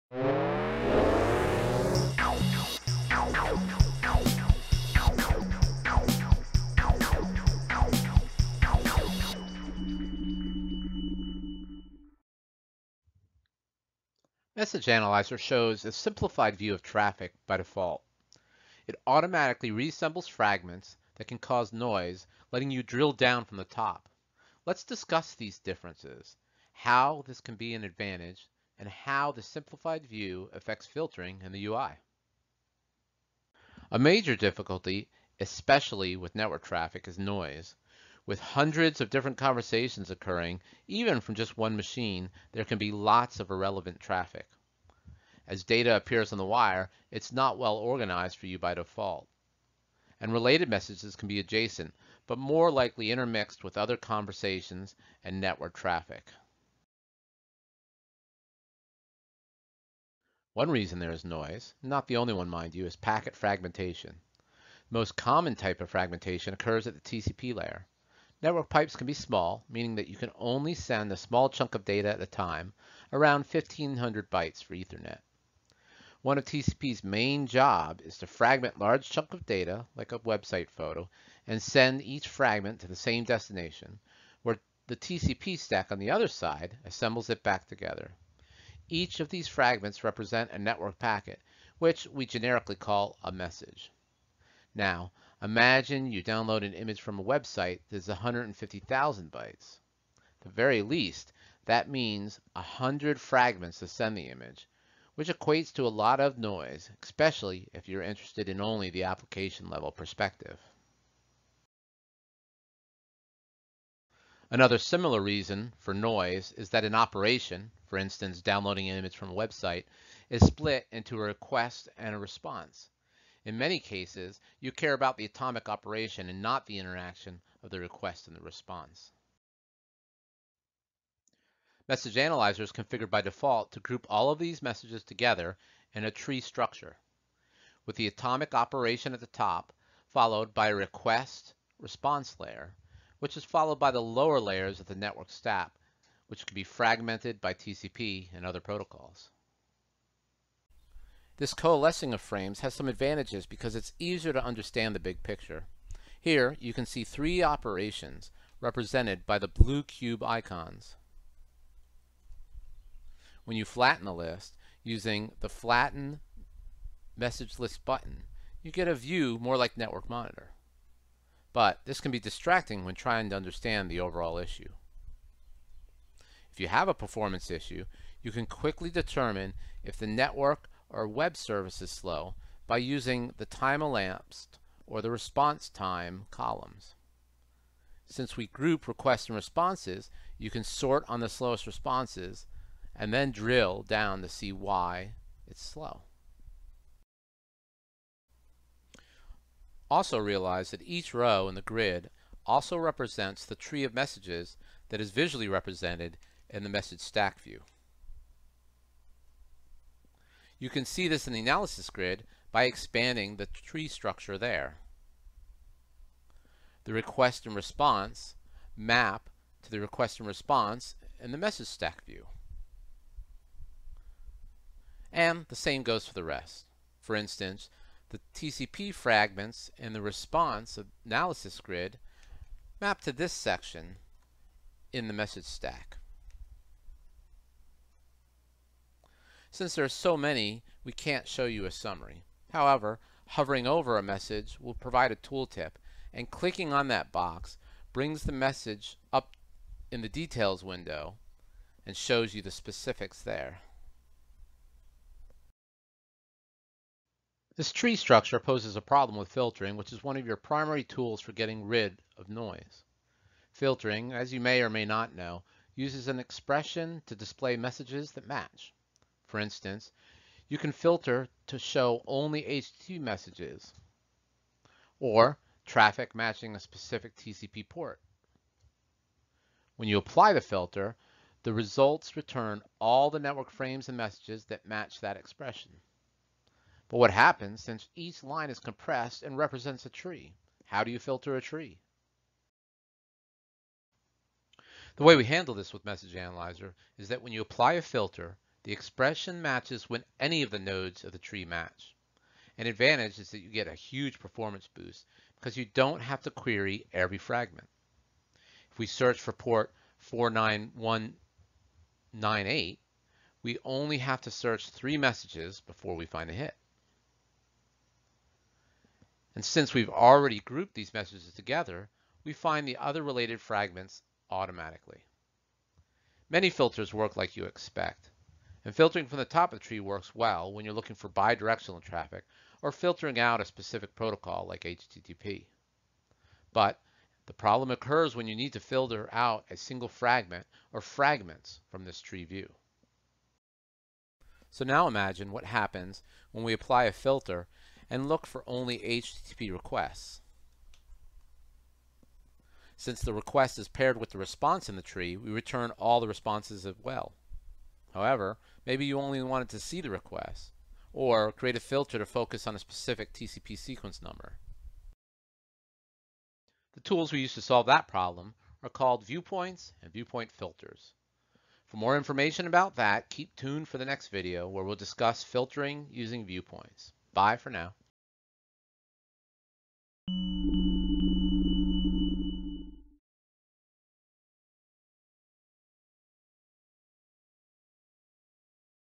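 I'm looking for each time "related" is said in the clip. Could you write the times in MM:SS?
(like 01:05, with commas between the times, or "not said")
00:50, 05:23.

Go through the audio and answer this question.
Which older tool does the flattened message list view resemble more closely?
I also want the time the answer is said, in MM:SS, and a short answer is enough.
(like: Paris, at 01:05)
Network Monitor, at 02:49.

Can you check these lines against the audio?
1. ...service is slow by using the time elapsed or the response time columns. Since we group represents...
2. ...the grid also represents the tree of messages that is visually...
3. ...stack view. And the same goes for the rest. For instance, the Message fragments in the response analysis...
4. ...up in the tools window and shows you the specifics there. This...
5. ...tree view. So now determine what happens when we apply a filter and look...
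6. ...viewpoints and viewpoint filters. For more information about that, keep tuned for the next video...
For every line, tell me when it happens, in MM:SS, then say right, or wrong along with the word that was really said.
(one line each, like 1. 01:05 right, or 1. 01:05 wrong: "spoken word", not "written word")
1. 03:01 wrong: "requests", not "represents"
2. 03:21 right
3. 03:41 wrong: "TCP", not "Message"
4. 04:09 wrong: "details", not "tools"
5. 05:42 wrong: "imagine", not "determine"
6. 06:09 right.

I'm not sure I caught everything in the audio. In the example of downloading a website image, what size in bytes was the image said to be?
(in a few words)
150,000.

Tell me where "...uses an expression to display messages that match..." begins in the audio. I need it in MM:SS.
04:25.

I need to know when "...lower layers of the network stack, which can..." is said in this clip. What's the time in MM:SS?
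02:24.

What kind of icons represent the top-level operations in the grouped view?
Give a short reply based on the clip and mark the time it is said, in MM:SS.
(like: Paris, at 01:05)
blue cube icons, at 02:39.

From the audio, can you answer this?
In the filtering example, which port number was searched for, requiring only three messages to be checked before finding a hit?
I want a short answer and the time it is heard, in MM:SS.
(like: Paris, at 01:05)
49198, at 05:09.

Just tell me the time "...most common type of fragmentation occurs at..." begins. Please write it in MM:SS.
01:04.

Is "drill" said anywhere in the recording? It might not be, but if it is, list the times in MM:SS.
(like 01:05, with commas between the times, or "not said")
00:22, 03:13.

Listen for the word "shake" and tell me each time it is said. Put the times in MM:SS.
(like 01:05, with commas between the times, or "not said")
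not said.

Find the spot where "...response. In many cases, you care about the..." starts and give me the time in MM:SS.
02:02.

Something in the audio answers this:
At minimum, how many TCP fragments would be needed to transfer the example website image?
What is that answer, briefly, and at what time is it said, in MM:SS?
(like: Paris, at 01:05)
100, at 01:42.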